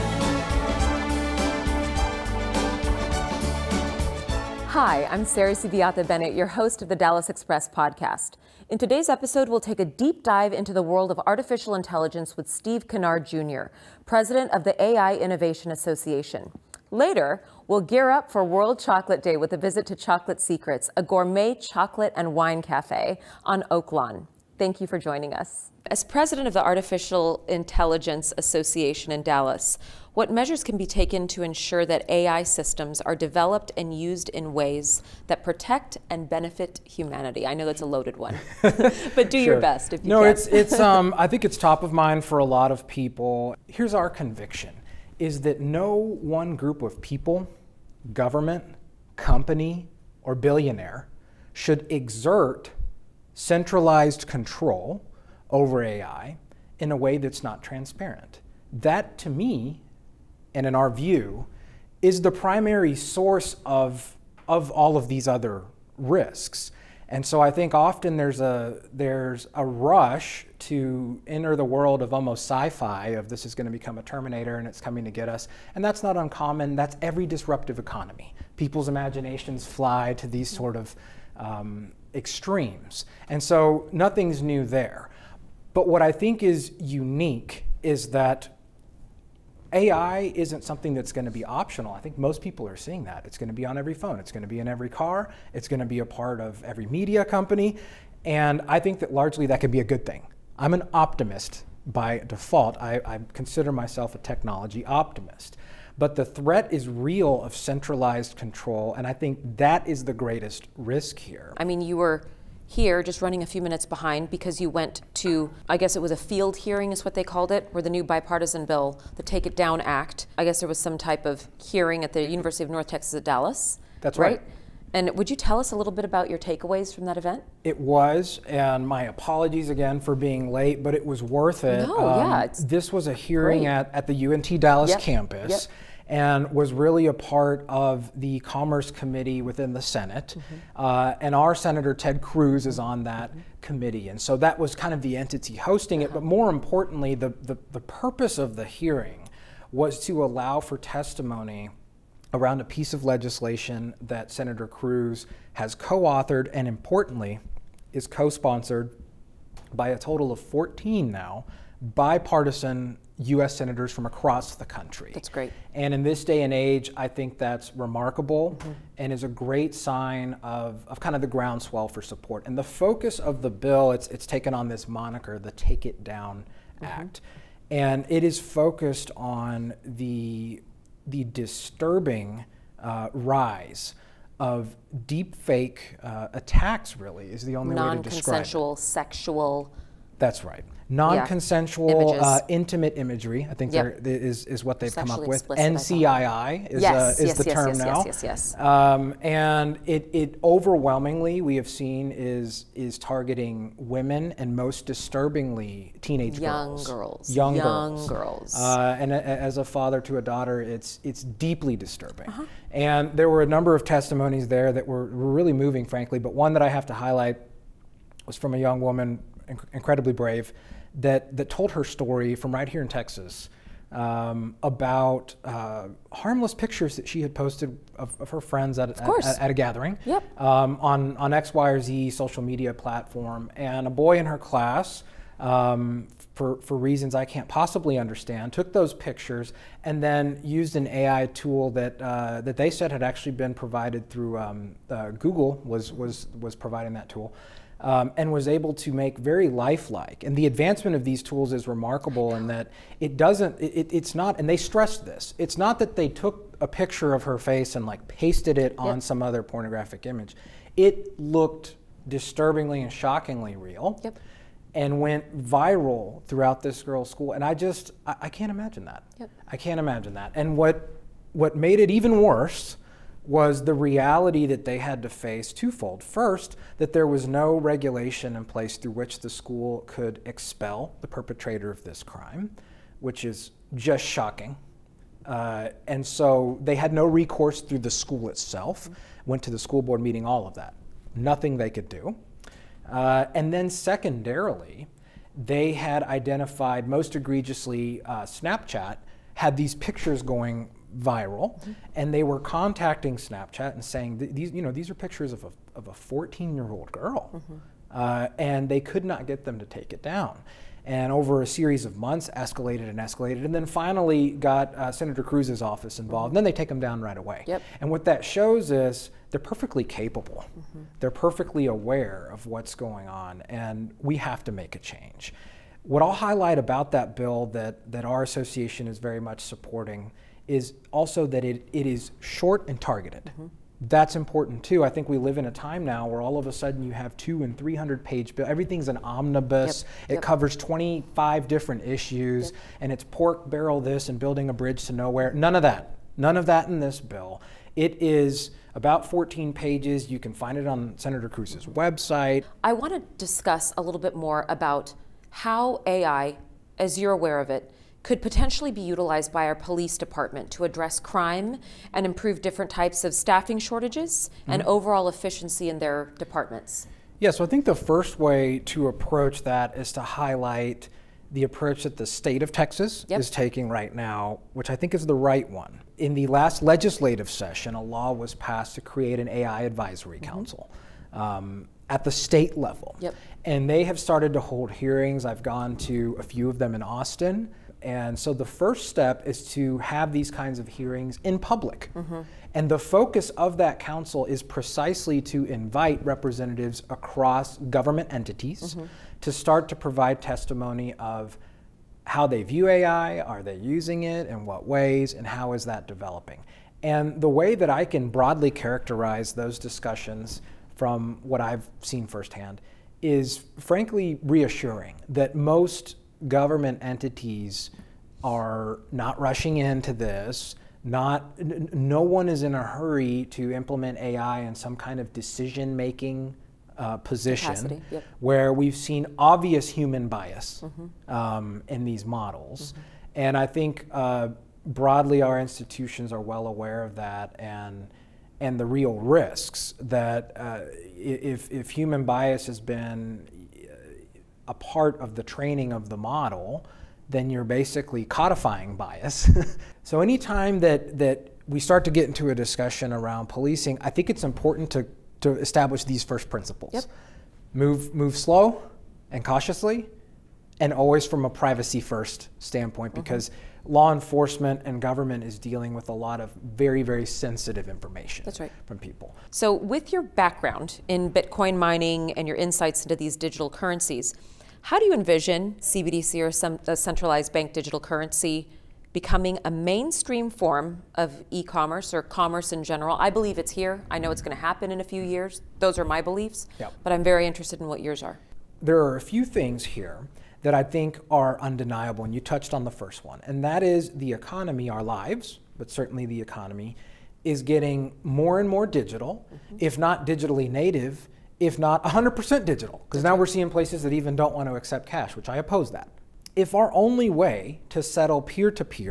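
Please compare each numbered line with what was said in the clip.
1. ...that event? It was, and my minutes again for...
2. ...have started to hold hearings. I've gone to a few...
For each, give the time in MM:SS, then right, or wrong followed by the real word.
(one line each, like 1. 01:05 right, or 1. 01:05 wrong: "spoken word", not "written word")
1. 02:07 wrong: "apologies", not "minutes"
2. 06:23 right.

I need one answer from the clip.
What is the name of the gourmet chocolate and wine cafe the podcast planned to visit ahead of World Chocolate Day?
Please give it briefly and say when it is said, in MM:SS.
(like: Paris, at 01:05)
Chocolate Secrets, at 00:19.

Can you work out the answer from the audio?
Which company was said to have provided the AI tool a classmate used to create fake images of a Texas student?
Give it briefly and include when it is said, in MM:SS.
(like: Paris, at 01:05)
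Google, at 04:05.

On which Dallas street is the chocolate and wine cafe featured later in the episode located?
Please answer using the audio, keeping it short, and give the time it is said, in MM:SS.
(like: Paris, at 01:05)
Oak Lawn, at 00:23.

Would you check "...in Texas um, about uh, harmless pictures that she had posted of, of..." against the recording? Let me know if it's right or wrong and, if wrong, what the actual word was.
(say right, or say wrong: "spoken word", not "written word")
right.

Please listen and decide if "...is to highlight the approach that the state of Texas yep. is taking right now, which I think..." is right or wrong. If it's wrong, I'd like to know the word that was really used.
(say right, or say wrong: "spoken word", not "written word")
right.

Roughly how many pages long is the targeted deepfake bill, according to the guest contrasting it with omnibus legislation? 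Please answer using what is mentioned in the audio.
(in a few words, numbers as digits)
14 pages.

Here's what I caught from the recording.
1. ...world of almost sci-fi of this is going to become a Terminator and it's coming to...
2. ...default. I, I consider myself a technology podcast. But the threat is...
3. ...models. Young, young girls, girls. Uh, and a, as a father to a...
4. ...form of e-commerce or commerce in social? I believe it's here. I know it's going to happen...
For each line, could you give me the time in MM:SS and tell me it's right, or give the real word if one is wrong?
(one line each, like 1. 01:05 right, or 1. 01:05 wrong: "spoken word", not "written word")
1. 01:11 right
2. 01:42 wrong: "optimist", not "podcast"
3. 03:26 wrong: "girls", not "models"
4. 08:00 wrong: "general", not "social".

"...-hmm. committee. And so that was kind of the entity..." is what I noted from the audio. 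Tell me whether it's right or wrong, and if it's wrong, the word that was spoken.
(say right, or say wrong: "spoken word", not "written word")
right.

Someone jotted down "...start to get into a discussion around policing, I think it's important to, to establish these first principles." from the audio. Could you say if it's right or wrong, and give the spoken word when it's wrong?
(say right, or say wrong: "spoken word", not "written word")
right.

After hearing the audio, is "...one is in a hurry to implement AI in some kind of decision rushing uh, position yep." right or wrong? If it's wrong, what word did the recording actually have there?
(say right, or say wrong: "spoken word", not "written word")
wrong: "making", not "rushing".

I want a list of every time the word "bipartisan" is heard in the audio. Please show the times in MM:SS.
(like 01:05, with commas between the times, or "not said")
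01:58, 02:41.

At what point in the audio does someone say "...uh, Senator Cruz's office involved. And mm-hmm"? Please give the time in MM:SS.
05:14.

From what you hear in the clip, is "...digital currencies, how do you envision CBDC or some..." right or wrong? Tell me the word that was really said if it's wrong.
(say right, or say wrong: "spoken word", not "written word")
right.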